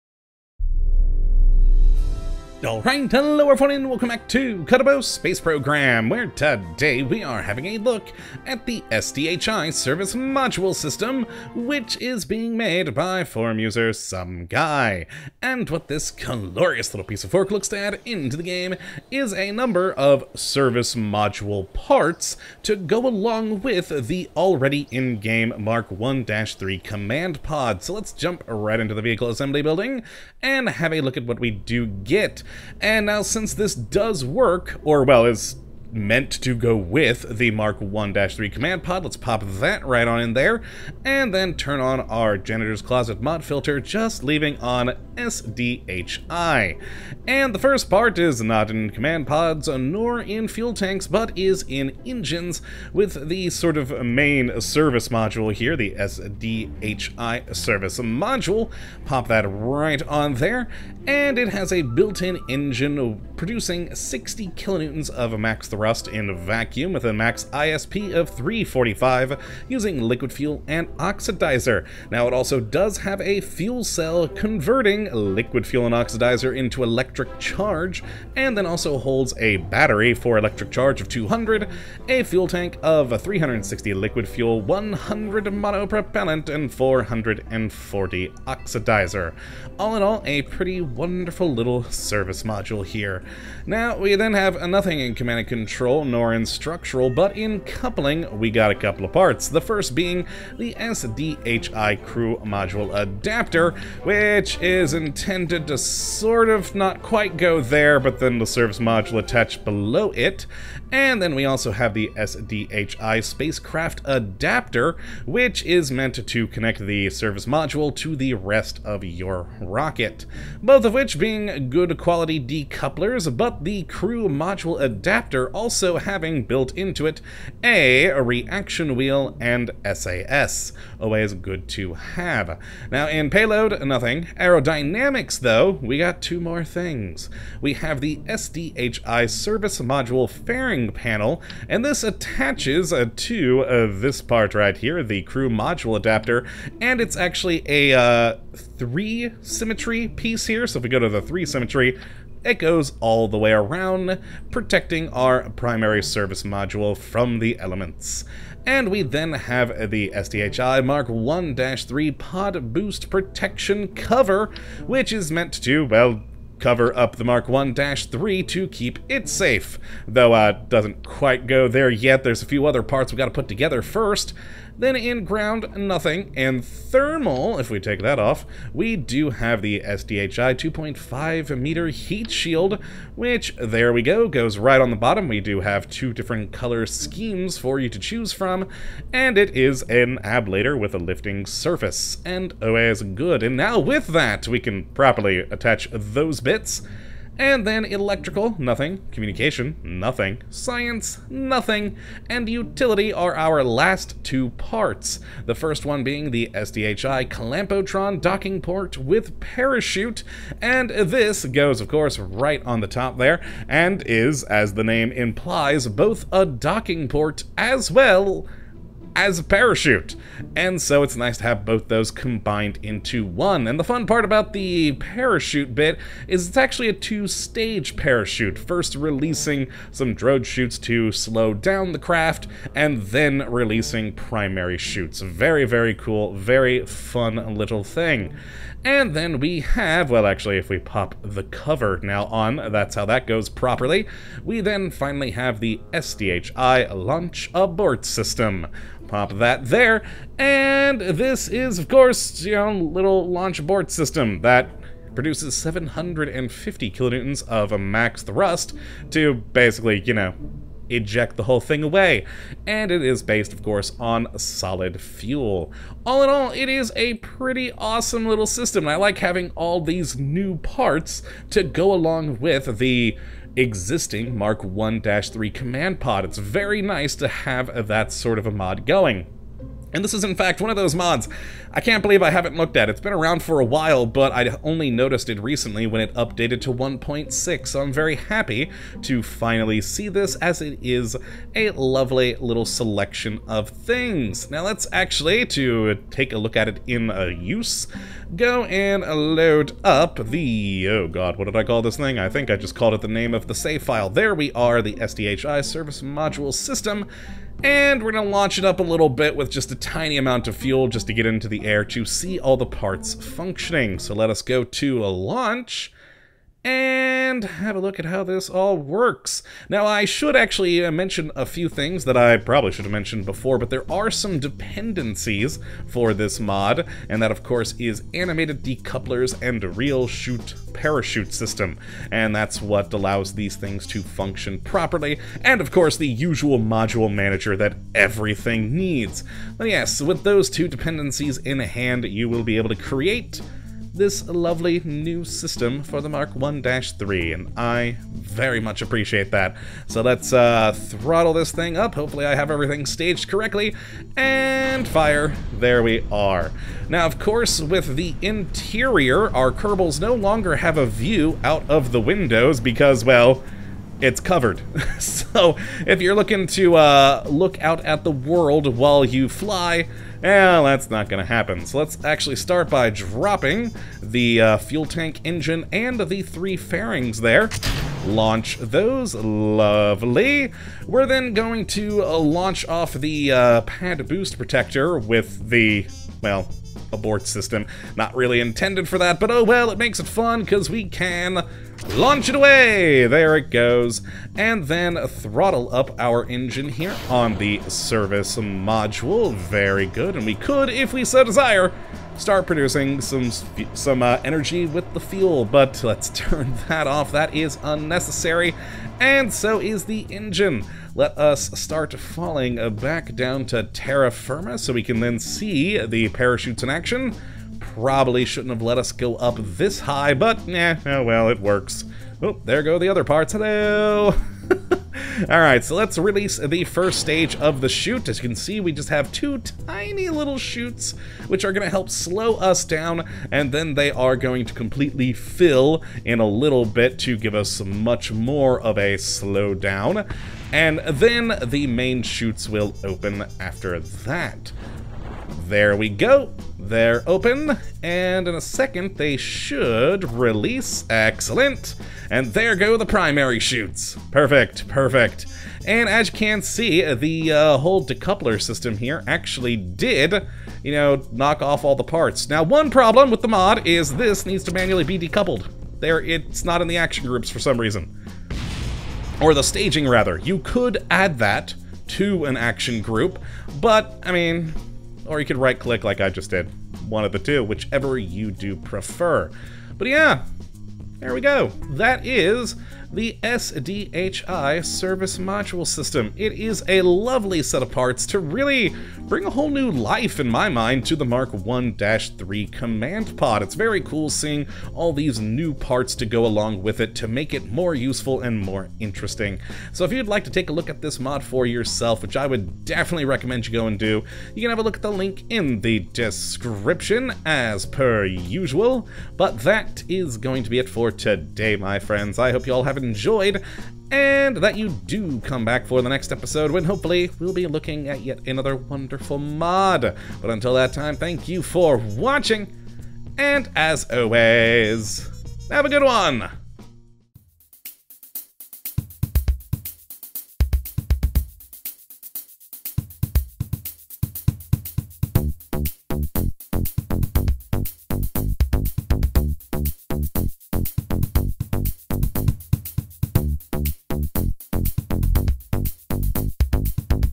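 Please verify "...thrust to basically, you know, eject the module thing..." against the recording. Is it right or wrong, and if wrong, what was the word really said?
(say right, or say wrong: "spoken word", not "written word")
wrong: "whole", not "module".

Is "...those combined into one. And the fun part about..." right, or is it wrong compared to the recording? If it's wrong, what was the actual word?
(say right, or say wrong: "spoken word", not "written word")
right.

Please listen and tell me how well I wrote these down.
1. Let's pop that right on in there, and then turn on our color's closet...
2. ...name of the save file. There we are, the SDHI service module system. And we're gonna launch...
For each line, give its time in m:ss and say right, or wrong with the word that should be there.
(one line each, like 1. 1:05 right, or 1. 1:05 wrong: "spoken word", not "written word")
1. 0:39 wrong: "janitor", not "color"
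2. 5:03 right.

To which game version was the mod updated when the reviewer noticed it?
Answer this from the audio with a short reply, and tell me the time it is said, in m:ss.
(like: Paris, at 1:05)
1.6, at 4:46.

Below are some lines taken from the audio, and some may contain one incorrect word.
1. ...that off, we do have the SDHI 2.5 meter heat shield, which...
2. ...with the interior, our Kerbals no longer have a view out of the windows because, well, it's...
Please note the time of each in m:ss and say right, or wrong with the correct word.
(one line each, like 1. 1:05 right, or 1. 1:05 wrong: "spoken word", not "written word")
1. 2:58 right
2. 5:57 right.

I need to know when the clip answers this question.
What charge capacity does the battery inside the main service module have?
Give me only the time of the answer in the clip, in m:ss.
1:21.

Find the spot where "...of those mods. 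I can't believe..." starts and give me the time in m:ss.
4:40.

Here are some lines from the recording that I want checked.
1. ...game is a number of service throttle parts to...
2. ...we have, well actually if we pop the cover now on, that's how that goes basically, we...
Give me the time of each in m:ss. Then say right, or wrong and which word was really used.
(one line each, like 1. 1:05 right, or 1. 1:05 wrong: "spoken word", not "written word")
1. 0:18 wrong: "module", not "throttle"
2. 3:59 wrong: "properly", not "basically".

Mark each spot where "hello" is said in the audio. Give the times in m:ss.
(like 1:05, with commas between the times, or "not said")
0:03, 7:03.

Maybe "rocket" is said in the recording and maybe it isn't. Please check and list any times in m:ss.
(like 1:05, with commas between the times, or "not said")
1:59.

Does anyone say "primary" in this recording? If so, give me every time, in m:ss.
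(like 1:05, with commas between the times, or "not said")
2:35, 3:54, 7:32.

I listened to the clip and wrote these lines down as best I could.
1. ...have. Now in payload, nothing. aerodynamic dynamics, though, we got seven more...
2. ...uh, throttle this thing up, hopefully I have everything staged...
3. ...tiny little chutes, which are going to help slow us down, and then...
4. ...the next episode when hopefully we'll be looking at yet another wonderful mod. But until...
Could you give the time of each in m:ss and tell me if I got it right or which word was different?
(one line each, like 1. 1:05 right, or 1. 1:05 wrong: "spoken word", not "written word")
1. 2:11 wrong: "two", not "seven"
2. 5:50 right
3. 7:09 right
4. 8:35 right.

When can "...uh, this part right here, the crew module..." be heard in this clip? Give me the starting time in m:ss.
2:23.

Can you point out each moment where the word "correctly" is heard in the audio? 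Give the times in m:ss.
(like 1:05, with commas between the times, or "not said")
5:53.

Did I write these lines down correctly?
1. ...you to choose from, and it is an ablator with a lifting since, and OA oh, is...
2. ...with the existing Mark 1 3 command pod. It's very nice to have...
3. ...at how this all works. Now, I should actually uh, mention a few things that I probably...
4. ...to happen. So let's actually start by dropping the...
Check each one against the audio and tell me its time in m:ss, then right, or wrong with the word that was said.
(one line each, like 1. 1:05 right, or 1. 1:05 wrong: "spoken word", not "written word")
1. 3:07 wrong: "surface", not "since"
2. 4:32 right
3. 5:17 right
4. 6:11 right.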